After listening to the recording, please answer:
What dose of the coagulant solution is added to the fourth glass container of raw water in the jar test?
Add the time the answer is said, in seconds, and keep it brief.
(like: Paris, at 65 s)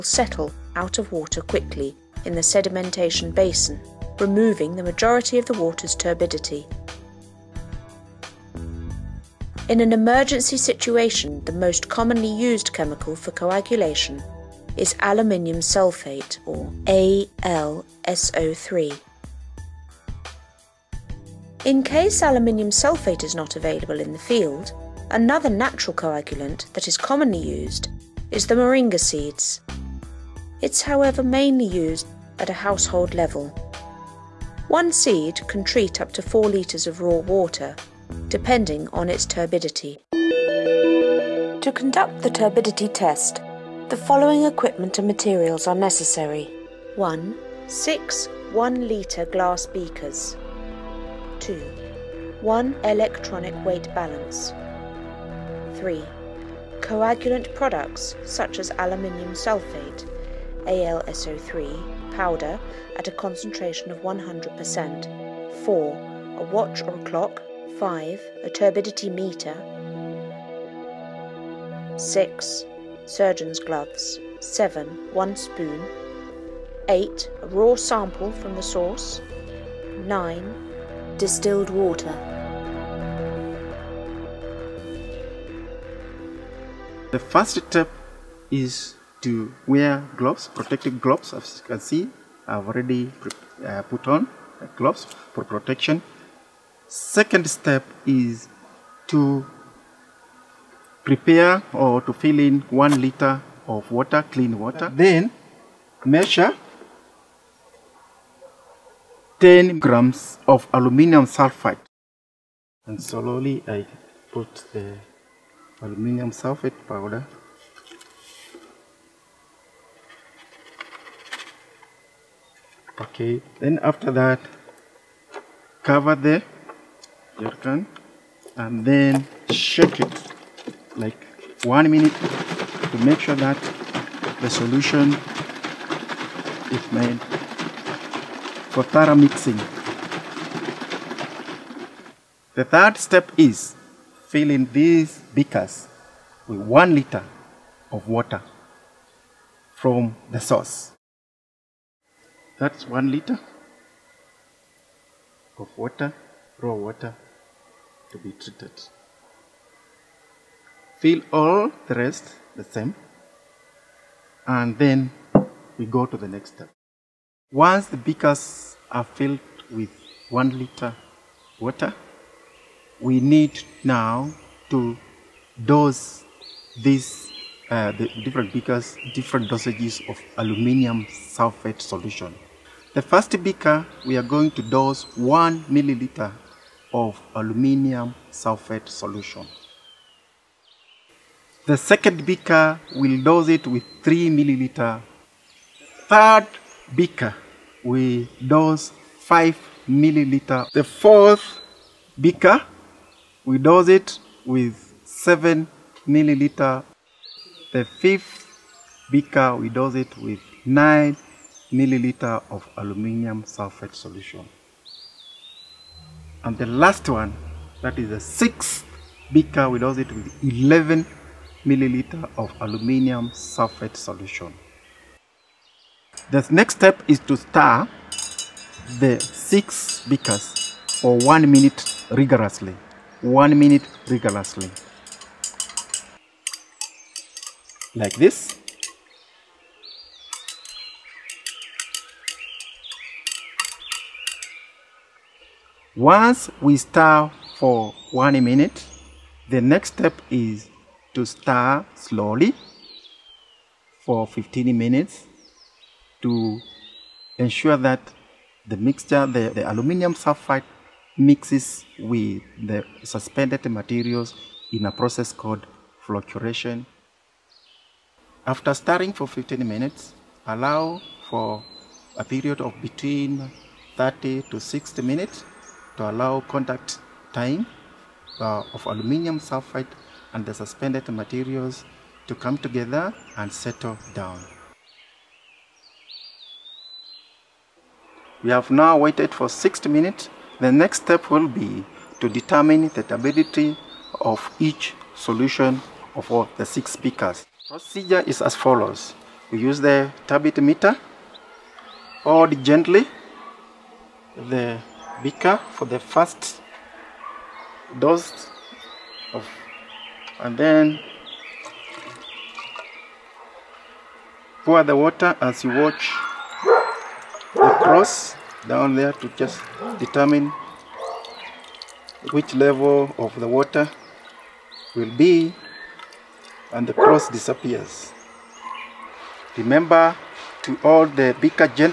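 7 milliliters, at 205 s.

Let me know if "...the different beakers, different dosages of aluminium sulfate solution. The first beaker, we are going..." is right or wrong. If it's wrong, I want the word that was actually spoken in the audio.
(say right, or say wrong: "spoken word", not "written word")
right.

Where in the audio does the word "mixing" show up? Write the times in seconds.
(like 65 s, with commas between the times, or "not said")
139 s.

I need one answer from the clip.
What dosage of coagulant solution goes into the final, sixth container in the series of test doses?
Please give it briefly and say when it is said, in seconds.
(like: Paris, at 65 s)
11 milliliters, at 220 s.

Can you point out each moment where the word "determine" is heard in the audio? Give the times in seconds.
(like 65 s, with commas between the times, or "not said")
292 s, 319 s.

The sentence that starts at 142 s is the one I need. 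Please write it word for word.
The third step is filling these beakers with one liter of water from the source.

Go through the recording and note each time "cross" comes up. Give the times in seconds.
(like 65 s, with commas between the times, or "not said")
317 s, 326 s.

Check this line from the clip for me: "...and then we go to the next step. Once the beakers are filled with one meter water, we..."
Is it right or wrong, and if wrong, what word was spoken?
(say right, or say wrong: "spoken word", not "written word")
wrong: "liter", not "meter".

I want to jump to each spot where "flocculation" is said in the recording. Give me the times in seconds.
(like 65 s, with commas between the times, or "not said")
266 s.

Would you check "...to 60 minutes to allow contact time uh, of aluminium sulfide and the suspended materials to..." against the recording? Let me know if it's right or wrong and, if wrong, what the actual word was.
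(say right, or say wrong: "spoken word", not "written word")
right.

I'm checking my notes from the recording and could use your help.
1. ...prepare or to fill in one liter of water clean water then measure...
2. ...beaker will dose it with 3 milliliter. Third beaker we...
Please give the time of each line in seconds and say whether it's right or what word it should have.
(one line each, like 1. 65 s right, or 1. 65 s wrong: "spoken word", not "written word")
1. 101 s right
2. 192 s right.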